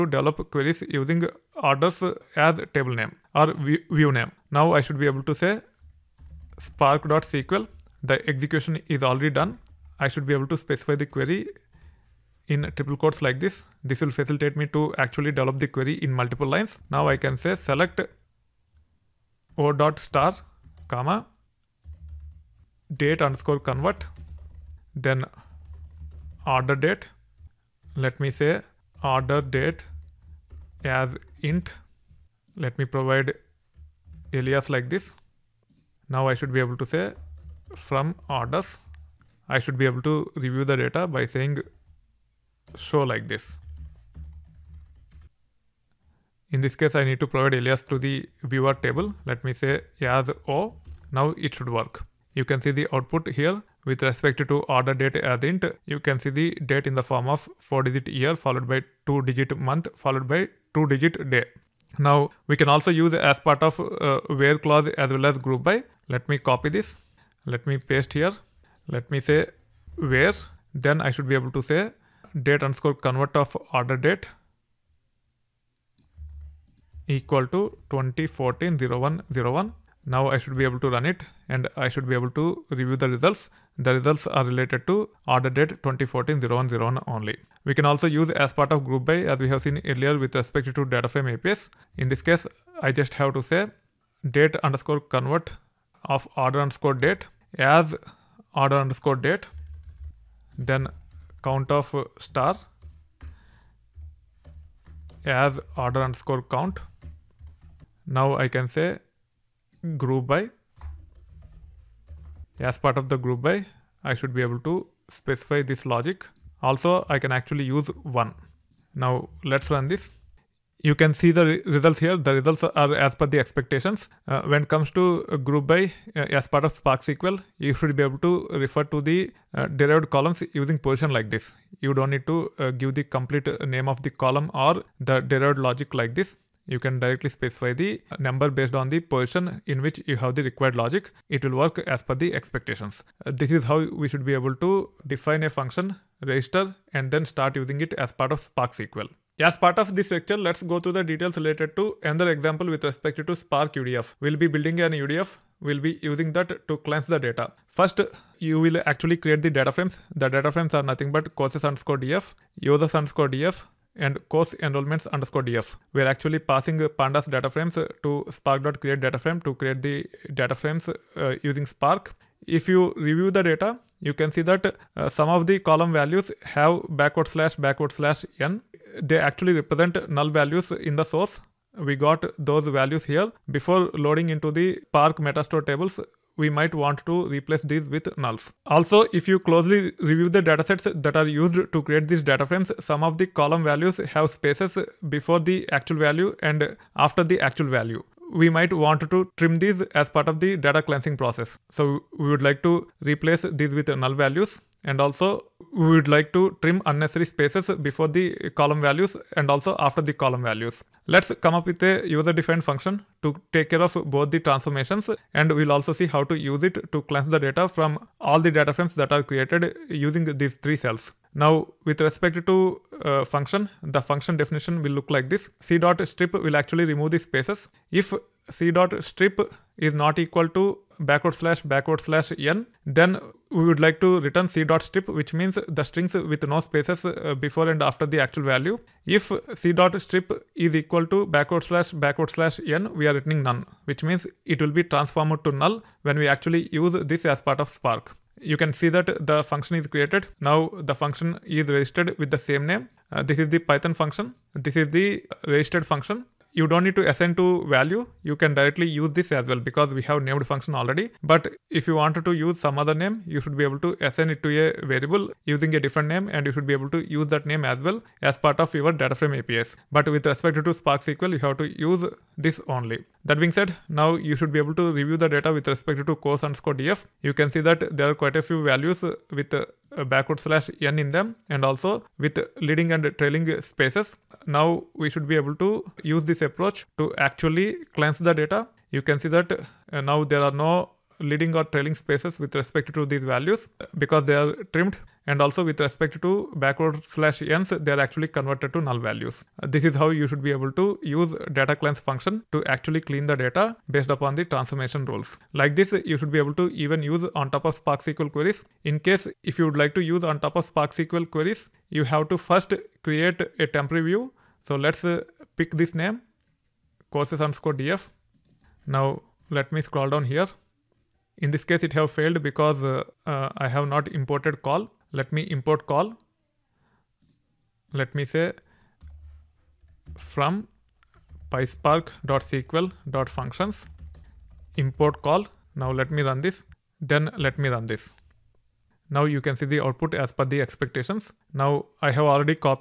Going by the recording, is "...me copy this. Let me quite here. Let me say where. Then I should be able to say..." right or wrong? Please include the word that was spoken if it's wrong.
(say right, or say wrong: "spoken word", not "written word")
wrong: "paste", not "quite".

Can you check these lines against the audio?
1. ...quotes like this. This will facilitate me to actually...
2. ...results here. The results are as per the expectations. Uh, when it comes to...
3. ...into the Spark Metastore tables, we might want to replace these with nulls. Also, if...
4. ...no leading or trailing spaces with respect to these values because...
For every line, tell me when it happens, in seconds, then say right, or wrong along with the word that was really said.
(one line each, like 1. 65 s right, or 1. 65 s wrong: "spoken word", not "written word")
1. 12 s right
2. 121 s right
3. 184 s right
4. 290 s right.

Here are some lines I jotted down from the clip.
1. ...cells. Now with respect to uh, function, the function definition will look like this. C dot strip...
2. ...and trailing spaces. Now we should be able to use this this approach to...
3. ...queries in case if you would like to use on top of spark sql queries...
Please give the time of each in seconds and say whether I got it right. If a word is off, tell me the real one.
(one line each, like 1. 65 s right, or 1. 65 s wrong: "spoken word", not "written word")
1. 220 s right
2. 282 s right
3. 308 s right.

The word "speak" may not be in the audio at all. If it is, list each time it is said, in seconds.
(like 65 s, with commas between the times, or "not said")
not said.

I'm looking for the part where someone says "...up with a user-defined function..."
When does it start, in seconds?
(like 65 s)
211 s.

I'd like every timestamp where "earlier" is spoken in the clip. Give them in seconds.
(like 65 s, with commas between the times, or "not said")
89 s.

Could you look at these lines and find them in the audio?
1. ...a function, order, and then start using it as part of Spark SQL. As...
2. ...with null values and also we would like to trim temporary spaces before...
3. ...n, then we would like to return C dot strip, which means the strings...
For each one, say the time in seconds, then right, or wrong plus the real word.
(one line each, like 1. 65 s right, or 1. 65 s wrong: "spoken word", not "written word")
1. 145 s wrong: "register", not "order"
2. 203 s wrong: "unnecessary", not "temporary"
3. 232 s right.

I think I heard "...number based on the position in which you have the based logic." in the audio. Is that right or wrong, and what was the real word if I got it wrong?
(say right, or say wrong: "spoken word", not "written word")
wrong: "required", not "based".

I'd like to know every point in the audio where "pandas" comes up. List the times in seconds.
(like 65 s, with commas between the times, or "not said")
166 s.